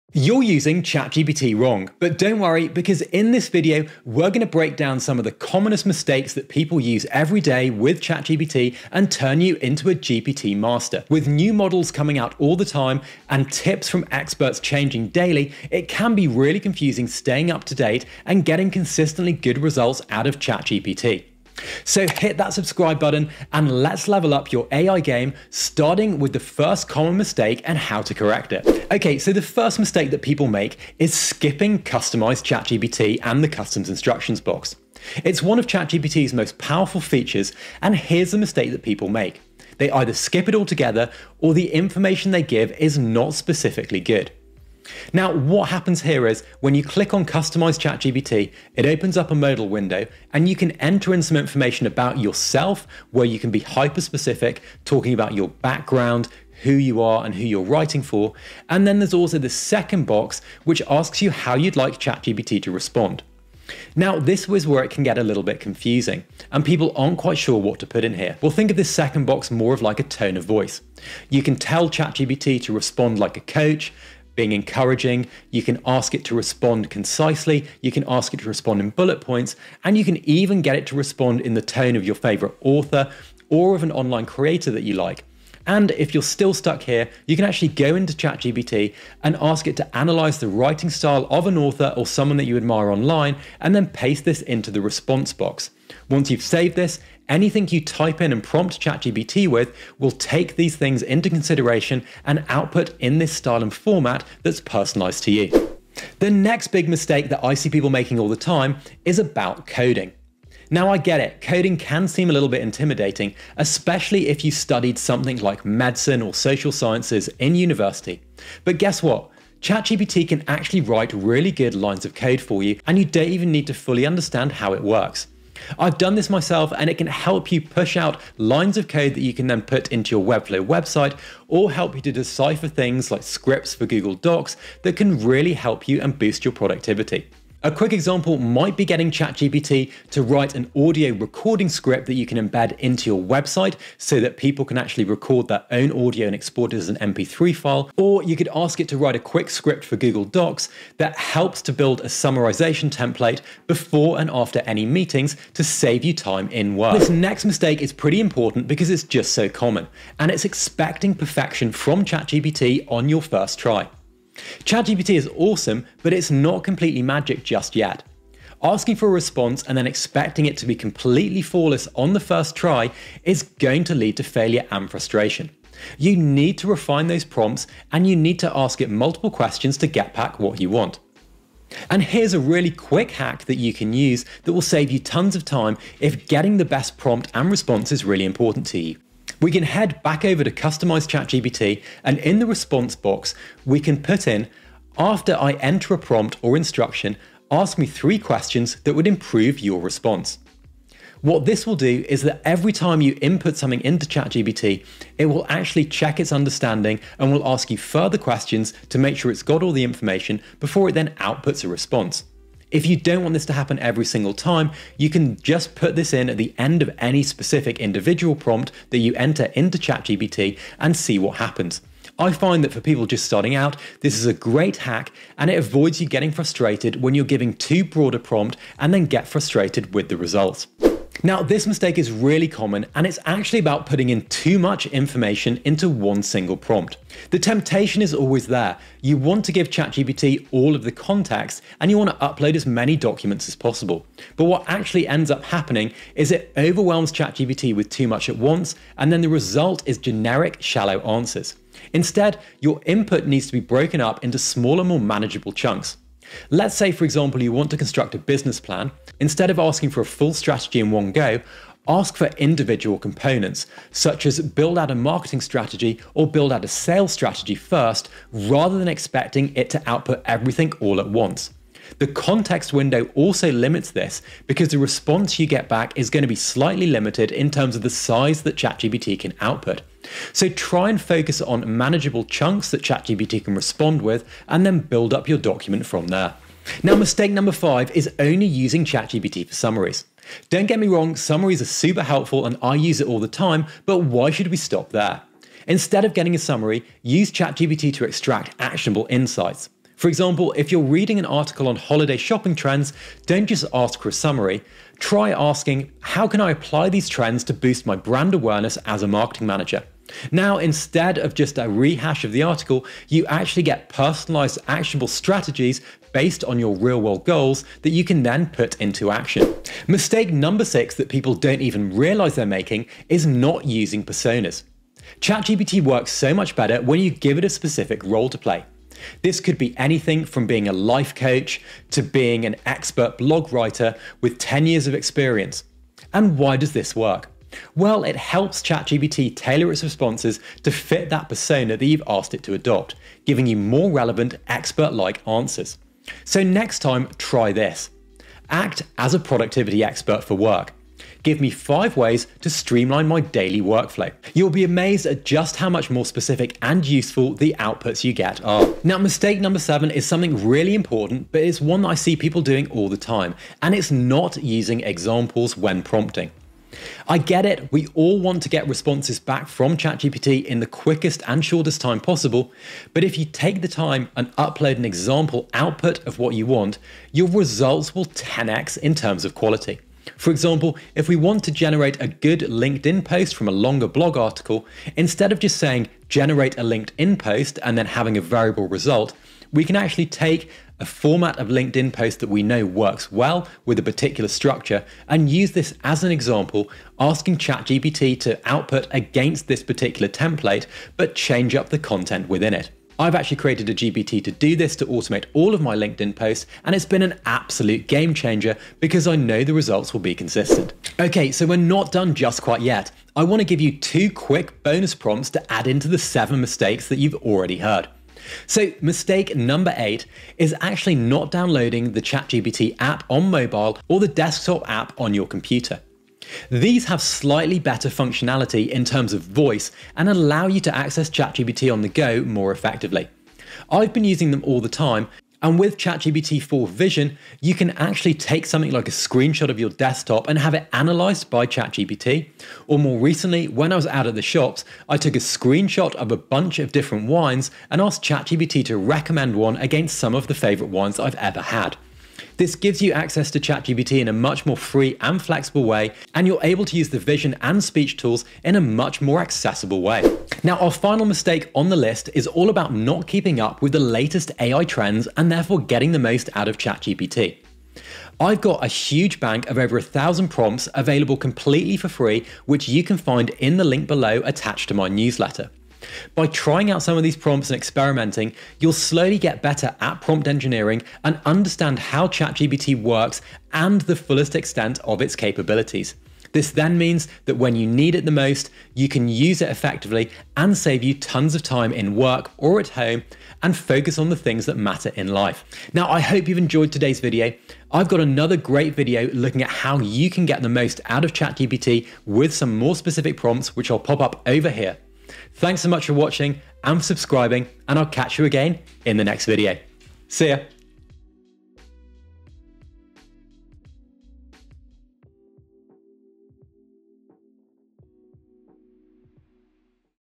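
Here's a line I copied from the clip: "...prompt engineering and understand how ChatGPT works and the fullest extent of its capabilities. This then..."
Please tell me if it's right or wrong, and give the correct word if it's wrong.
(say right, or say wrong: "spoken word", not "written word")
right.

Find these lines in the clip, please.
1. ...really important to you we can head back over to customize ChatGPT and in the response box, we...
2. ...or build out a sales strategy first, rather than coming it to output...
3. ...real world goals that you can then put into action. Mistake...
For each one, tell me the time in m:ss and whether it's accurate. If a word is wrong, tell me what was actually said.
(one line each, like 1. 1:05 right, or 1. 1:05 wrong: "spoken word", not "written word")
1. 3:08 right
2. 4:26 wrong: "expecting", not "coming"
3. 5:16 right.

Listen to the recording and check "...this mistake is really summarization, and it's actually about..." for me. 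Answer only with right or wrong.
wrong.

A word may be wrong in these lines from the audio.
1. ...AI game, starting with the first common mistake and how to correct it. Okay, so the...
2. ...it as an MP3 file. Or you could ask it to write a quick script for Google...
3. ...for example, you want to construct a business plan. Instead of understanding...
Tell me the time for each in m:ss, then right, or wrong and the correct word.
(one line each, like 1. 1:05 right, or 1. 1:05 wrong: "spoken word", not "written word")
1. 0:24 right
2. 2:26 right
3. 4:16 wrong: "asking", not "understanding".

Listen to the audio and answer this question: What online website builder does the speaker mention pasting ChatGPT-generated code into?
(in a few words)
Webflow.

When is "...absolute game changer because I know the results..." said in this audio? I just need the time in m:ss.
6:47.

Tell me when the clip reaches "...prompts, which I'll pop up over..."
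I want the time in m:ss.
8:23.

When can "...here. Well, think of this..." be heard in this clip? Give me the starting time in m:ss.
1:08.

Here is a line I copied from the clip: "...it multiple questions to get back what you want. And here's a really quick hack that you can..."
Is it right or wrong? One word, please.
right.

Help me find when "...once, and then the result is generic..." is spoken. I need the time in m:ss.
4:08.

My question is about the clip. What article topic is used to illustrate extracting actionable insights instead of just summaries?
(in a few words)
holiday shopping trends.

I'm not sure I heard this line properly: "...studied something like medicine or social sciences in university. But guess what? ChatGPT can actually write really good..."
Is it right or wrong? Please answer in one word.
right.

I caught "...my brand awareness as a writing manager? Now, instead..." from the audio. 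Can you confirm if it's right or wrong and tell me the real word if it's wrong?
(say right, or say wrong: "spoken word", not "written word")
wrong: "marketing", not "writing".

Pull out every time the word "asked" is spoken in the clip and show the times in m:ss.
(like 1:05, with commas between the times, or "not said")
5:42, 7:27.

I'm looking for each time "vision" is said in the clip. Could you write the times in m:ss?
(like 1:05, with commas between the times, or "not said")
7:16, 7:36.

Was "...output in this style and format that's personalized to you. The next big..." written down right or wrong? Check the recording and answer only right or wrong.
right.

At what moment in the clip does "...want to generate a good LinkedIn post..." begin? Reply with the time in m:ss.
6:21.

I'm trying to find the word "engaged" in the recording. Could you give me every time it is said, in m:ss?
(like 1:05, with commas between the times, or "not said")
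not said.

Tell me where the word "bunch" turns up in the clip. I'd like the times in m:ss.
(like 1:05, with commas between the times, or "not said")
7:26.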